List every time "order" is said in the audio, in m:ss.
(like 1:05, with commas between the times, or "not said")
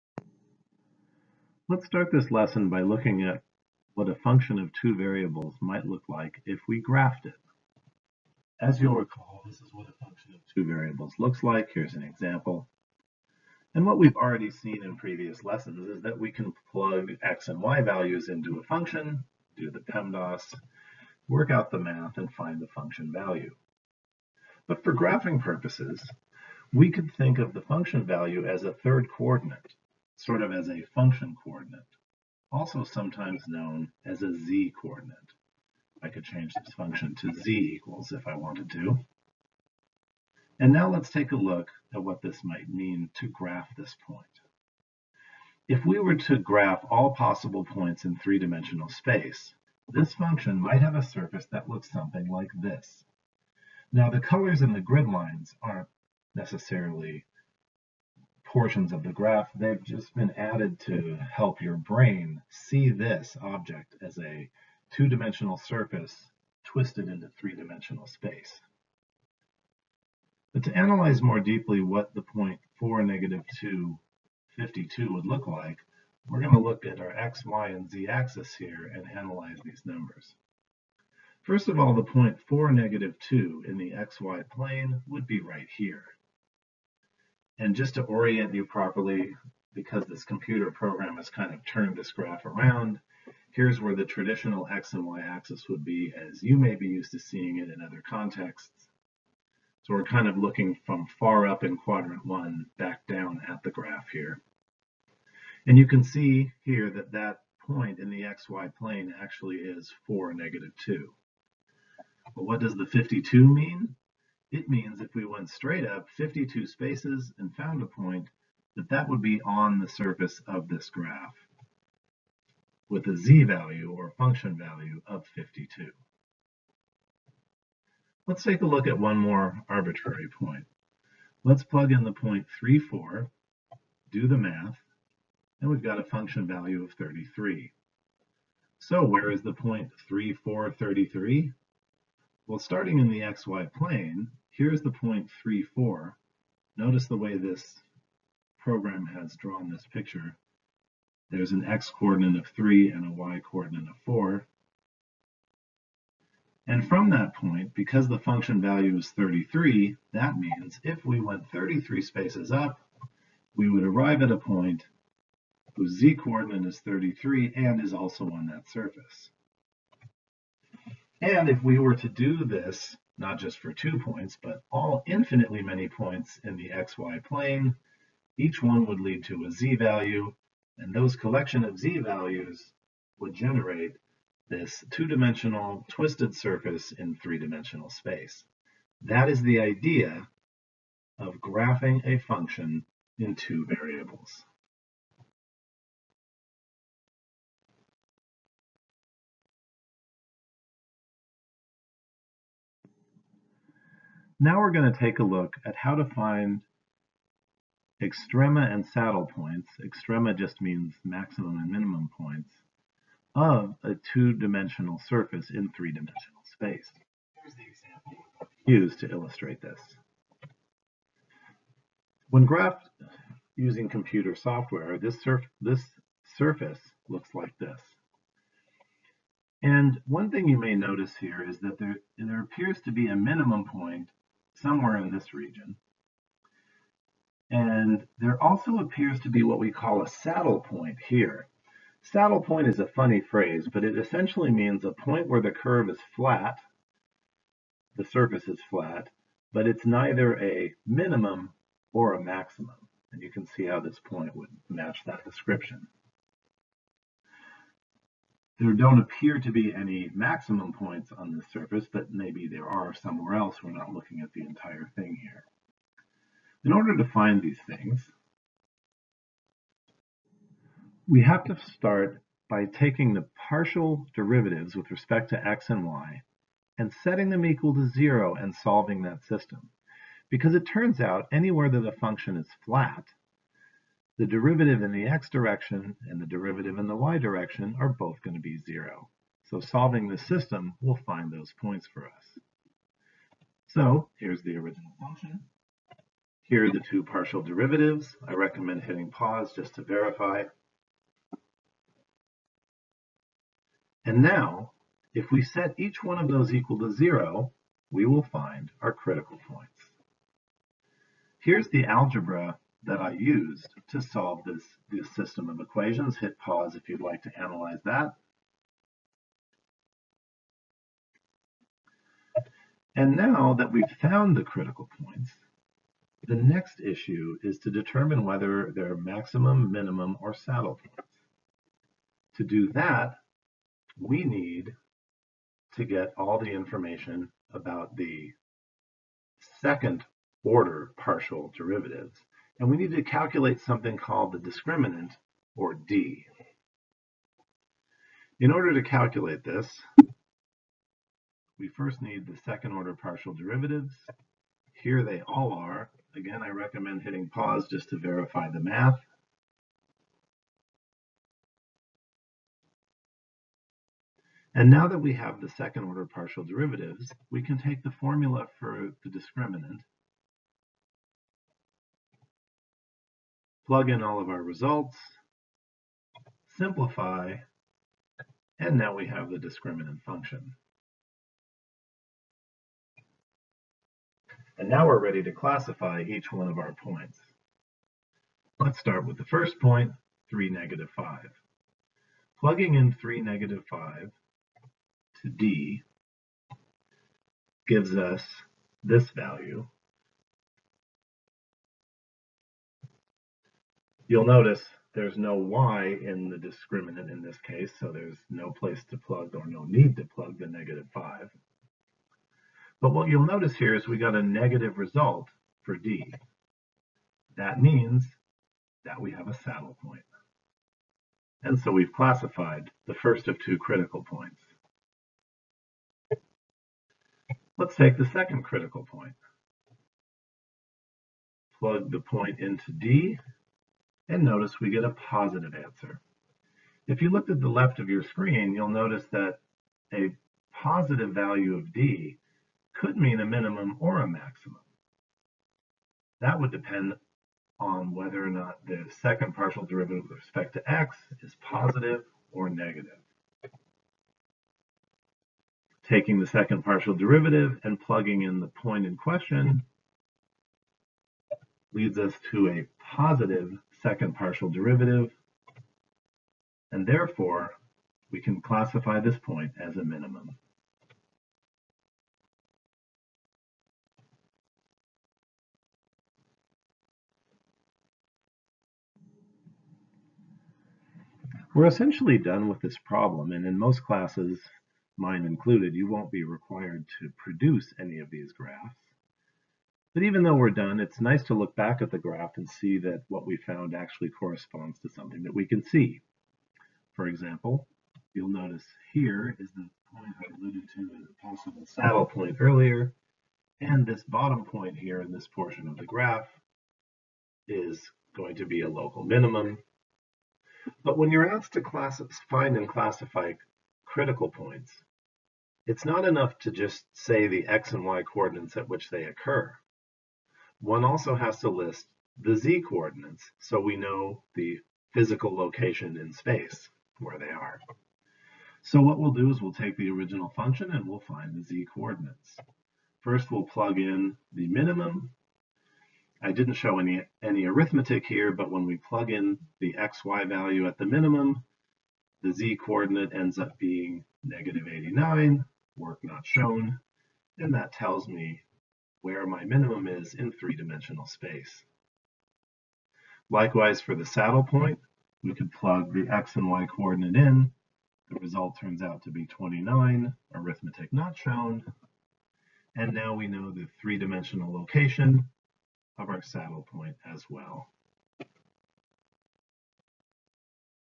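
4:26, 5:40, 5:48, 5:52, 6:05.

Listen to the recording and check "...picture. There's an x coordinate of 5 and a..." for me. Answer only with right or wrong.
wrong.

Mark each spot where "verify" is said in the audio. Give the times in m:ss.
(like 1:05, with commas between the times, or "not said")
4:59, 5:57.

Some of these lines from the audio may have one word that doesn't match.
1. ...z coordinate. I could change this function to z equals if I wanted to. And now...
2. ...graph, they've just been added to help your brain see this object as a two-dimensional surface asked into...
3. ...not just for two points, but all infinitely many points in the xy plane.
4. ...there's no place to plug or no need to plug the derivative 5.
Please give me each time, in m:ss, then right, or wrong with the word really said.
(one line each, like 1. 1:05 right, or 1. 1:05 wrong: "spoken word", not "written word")
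1. 0:34 right
2. 0:59 wrong: "twisted", not "asked"
3. 2:53 right
4. 6:47 wrong: "negative", not "derivative".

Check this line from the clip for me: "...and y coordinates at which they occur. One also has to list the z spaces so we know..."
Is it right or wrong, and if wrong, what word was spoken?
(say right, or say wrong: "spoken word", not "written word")
wrong: "coordinates", not "spaces".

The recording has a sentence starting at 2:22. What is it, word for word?
Well, starting in the xy plane, Here's the point 4.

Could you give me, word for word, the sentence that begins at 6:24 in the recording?
And now we're ready to classify each one of our points.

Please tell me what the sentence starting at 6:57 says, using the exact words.
That means that we have a saddle point.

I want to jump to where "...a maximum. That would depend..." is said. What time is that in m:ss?
7:24.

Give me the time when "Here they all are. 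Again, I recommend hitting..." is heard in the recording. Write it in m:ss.
5:54.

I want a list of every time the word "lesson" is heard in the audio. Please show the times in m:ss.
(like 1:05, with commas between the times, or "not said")
0:02, 0:15.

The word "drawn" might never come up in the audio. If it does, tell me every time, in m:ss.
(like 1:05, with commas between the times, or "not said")
2:29.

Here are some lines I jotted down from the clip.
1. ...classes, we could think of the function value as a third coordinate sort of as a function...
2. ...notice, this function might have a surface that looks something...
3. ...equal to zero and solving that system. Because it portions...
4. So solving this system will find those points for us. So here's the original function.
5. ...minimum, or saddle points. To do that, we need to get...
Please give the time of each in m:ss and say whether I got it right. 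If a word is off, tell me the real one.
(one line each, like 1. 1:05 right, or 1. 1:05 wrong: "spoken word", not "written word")
1. 0:25 wrong: "purposes", not "classes"
2. 0:48 wrong: "space", not "notice"
3. 4:37 wrong: "turns", not "portions"
4. 4:49 right
5. 5:29 right.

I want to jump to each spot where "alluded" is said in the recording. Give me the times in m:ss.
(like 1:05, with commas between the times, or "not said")
8:20.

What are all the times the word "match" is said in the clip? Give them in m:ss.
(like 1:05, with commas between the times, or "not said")
4:14.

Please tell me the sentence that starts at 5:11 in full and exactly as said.
Here's the algebra that I used to solve this, this system of equations.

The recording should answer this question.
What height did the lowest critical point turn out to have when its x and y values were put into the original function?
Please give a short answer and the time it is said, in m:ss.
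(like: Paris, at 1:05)
-89, at 9:04.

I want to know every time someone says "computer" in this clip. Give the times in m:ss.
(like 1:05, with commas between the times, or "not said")
1:30, 3:43.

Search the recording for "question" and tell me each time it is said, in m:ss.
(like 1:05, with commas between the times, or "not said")
7:38.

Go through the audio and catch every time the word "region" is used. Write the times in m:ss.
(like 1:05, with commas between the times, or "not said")
3:55.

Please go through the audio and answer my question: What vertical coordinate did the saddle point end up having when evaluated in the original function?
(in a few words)
29.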